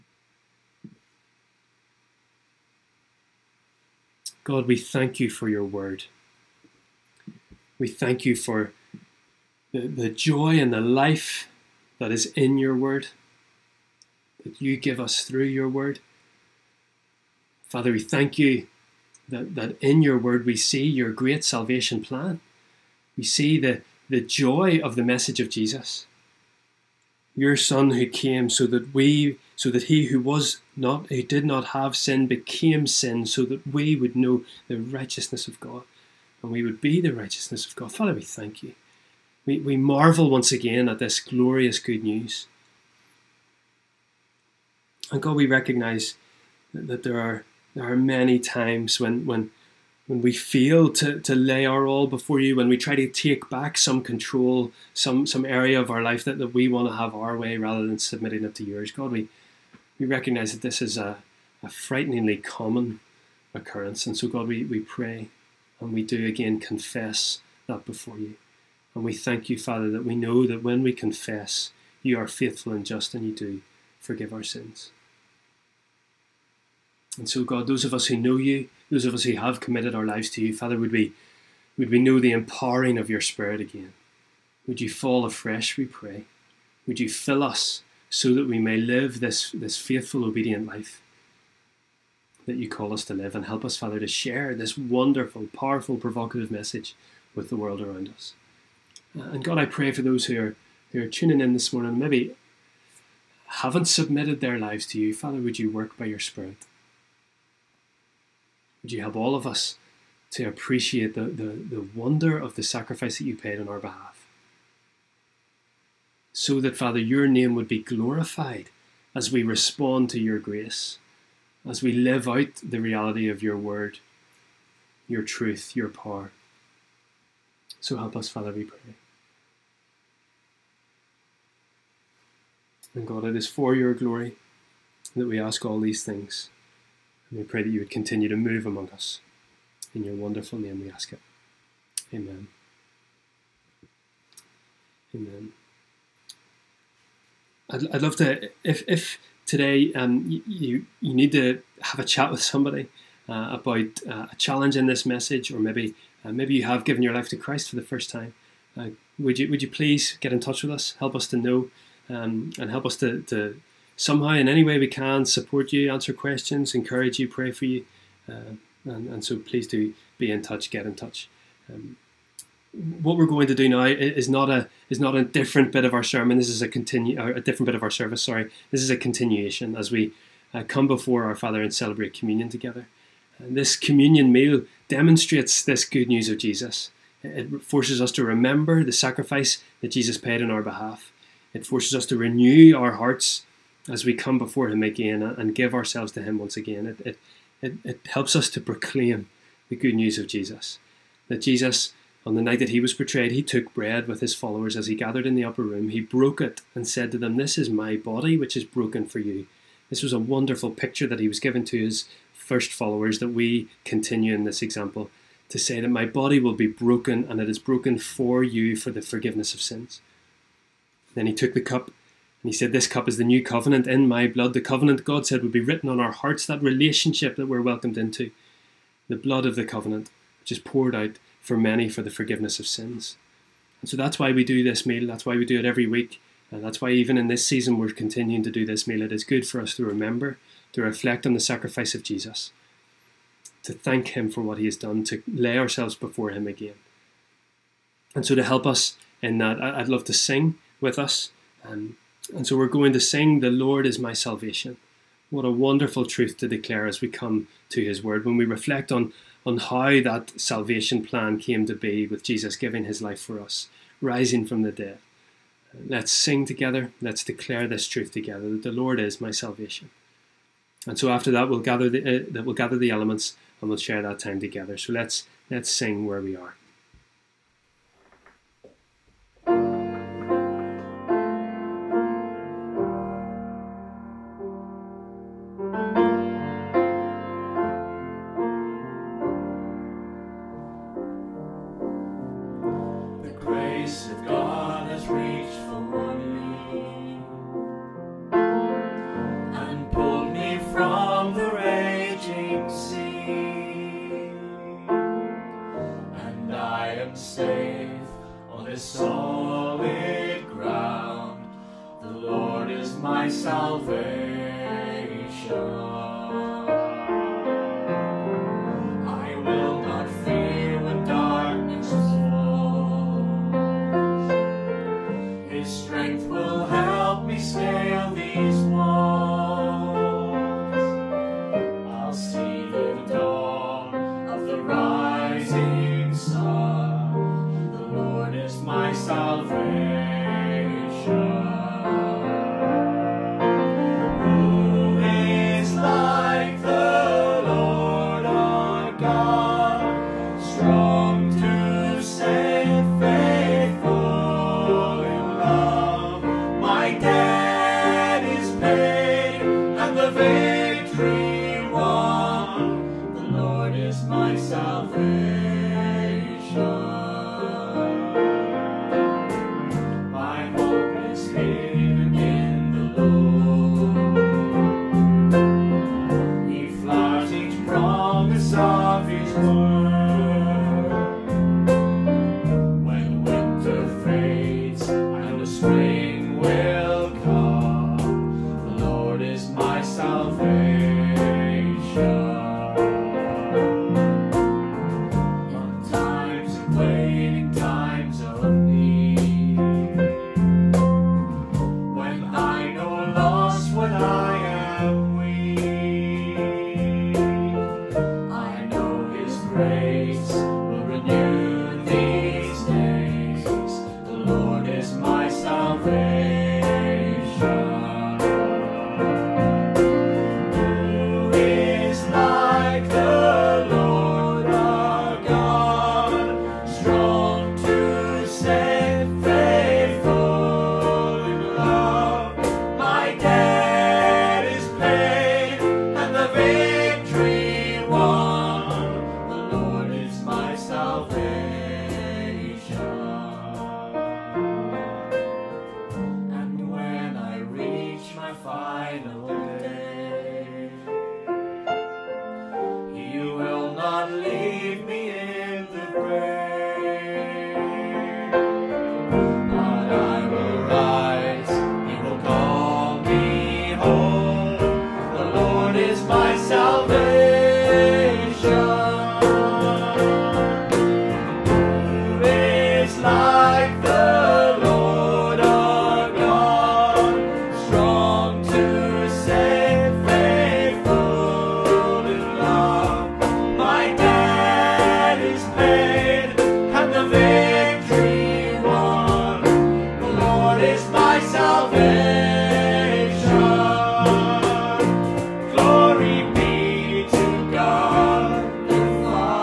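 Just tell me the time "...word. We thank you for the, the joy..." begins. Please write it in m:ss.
0:05.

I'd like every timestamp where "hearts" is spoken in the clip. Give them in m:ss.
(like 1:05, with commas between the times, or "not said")
3:12, 3:46.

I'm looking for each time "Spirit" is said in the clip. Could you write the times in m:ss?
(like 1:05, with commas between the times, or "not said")
1:23, 1:46.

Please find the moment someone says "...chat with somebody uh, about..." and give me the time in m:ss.
2:32.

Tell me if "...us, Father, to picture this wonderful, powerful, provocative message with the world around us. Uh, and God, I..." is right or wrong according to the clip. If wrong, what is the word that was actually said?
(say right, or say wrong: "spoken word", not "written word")
wrong: "share", not "picture".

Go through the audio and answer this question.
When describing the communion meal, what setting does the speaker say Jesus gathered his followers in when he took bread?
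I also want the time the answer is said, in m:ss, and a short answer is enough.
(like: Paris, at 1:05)
the upper room, at 3:25.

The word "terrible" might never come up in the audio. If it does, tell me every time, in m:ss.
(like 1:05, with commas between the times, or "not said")
not said.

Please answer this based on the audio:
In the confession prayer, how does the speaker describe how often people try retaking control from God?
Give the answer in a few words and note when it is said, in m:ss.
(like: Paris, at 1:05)
frighteningly common, at 1:01.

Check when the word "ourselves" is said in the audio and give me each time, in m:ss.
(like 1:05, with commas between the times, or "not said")
3:15, 4:05.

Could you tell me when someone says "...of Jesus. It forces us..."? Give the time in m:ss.
3:06.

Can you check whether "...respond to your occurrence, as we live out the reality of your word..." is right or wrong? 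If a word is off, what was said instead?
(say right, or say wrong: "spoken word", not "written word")
wrong: "grace", not "occurrence".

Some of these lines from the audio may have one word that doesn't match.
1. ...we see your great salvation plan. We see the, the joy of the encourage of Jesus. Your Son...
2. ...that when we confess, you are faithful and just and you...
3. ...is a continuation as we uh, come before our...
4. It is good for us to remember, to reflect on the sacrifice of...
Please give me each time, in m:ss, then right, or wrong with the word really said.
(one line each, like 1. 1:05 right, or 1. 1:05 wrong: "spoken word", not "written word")
1. 0:20 wrong: "message", not "encourage"
2. 1:10 right
3. 2:58 right
4. 3:59 right.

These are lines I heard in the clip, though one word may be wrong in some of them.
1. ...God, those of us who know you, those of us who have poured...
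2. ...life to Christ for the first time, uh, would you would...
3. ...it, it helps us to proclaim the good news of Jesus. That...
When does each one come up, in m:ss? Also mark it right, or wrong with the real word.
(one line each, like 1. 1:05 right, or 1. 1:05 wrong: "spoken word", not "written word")
1. 1:17 wrong: "committed", not "poured"
2. 2:37 right
3. 3:17 right.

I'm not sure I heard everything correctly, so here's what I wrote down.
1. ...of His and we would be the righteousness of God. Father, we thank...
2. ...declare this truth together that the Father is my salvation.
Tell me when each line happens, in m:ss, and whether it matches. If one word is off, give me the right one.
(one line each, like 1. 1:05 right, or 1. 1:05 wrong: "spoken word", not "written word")
1. 0:35 wrong: "God", not "His"
2. 4:27 wrong: "Lord", not "Father".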